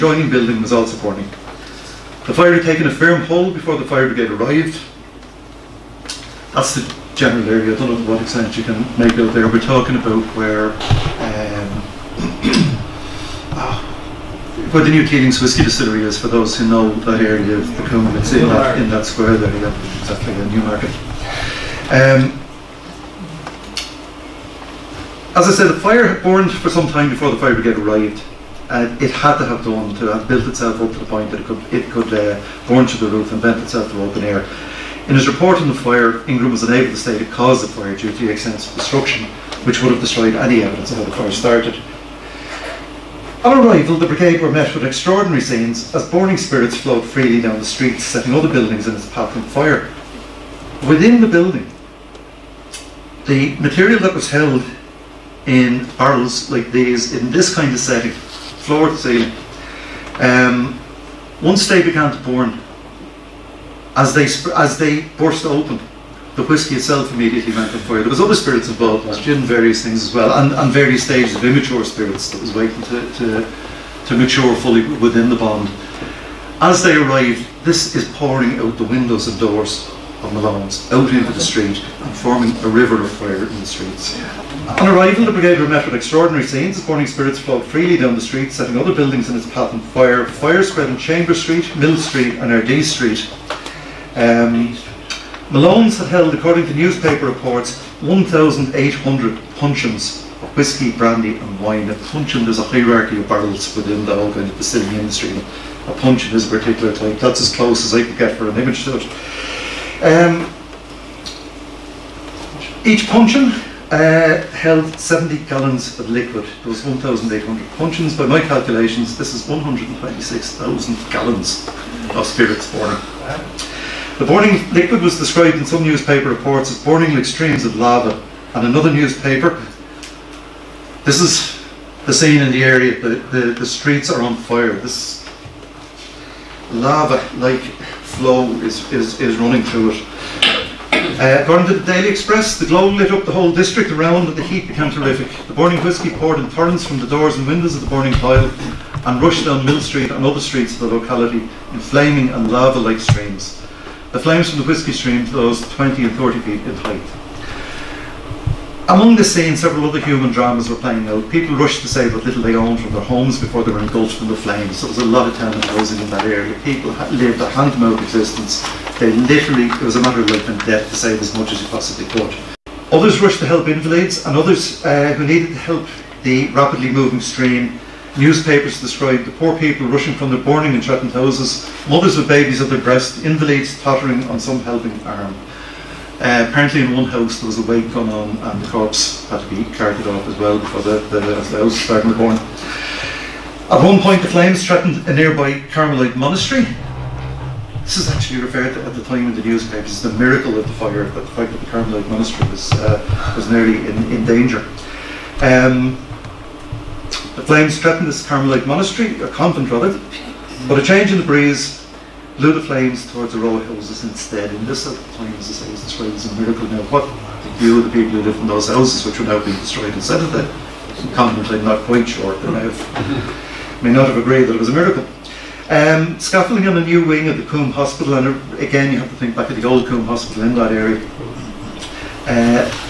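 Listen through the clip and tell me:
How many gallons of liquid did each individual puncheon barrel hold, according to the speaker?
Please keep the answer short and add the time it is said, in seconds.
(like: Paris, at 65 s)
70 gallons, at 114 s.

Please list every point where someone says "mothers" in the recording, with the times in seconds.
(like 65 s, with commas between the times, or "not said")
181 s.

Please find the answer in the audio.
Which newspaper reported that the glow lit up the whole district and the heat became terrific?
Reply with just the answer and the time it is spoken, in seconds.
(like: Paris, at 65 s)
Daily Express, at 141 s.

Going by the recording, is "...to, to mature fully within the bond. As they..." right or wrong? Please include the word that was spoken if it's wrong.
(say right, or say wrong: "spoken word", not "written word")
right.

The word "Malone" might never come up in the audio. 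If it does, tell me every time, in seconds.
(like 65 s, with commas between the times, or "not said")
80 s, 95 s.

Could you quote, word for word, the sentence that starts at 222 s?
They may, have, may not have agreed that it was a miracle.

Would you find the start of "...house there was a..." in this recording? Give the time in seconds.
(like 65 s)
187 s.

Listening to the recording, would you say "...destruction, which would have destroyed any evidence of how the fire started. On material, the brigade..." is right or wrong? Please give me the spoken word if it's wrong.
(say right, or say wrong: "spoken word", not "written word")
wrong: "arrival", not "material".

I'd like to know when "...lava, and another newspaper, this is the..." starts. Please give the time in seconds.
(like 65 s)
127 s.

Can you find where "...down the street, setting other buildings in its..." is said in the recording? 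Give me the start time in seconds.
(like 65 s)
87 s.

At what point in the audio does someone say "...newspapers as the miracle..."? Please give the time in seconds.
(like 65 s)
199 s.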